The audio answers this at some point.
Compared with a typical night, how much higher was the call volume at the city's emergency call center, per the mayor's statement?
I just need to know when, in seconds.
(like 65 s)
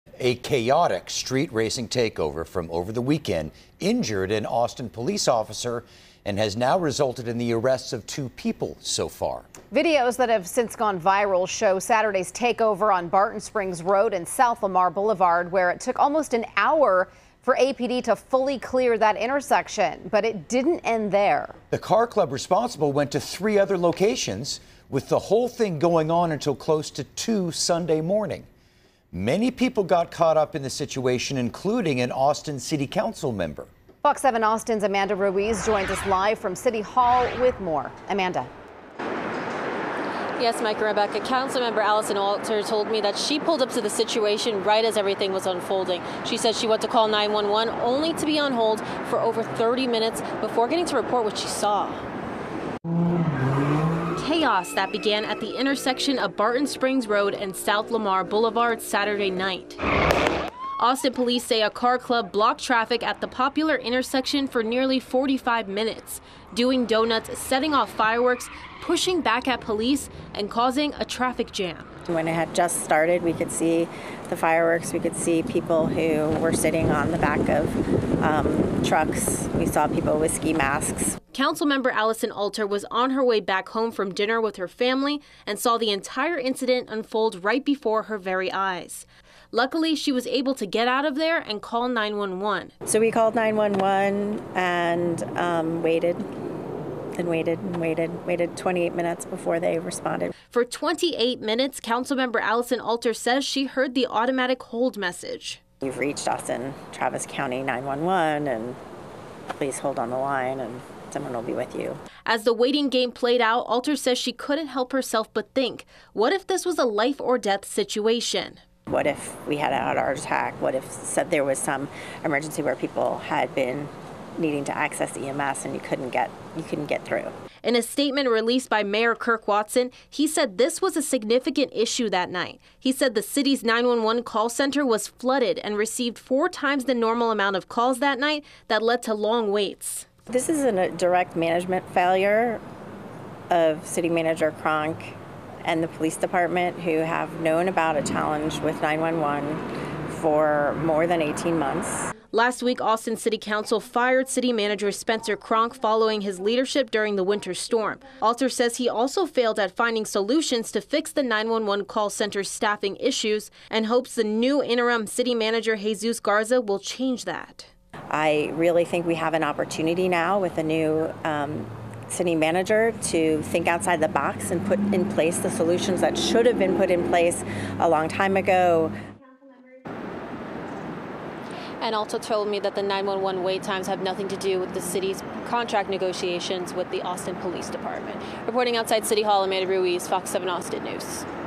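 136 s.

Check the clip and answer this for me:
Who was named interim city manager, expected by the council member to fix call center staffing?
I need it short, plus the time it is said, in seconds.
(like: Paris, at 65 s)
Jesus Garza, at 165 s.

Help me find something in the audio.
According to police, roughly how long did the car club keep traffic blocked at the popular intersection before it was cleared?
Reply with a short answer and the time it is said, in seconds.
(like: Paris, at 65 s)
45 minutes, at 64 s.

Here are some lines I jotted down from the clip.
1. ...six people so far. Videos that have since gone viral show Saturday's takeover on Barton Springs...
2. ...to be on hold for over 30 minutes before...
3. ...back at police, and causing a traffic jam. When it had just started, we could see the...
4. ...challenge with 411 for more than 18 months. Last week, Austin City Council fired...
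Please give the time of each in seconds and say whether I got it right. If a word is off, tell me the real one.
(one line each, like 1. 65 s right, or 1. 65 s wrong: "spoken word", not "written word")
1. 8 s wrong: "two", not "six"
2. 48 s right
3. 69 s right
4. 148 s wrong: "911", not "411".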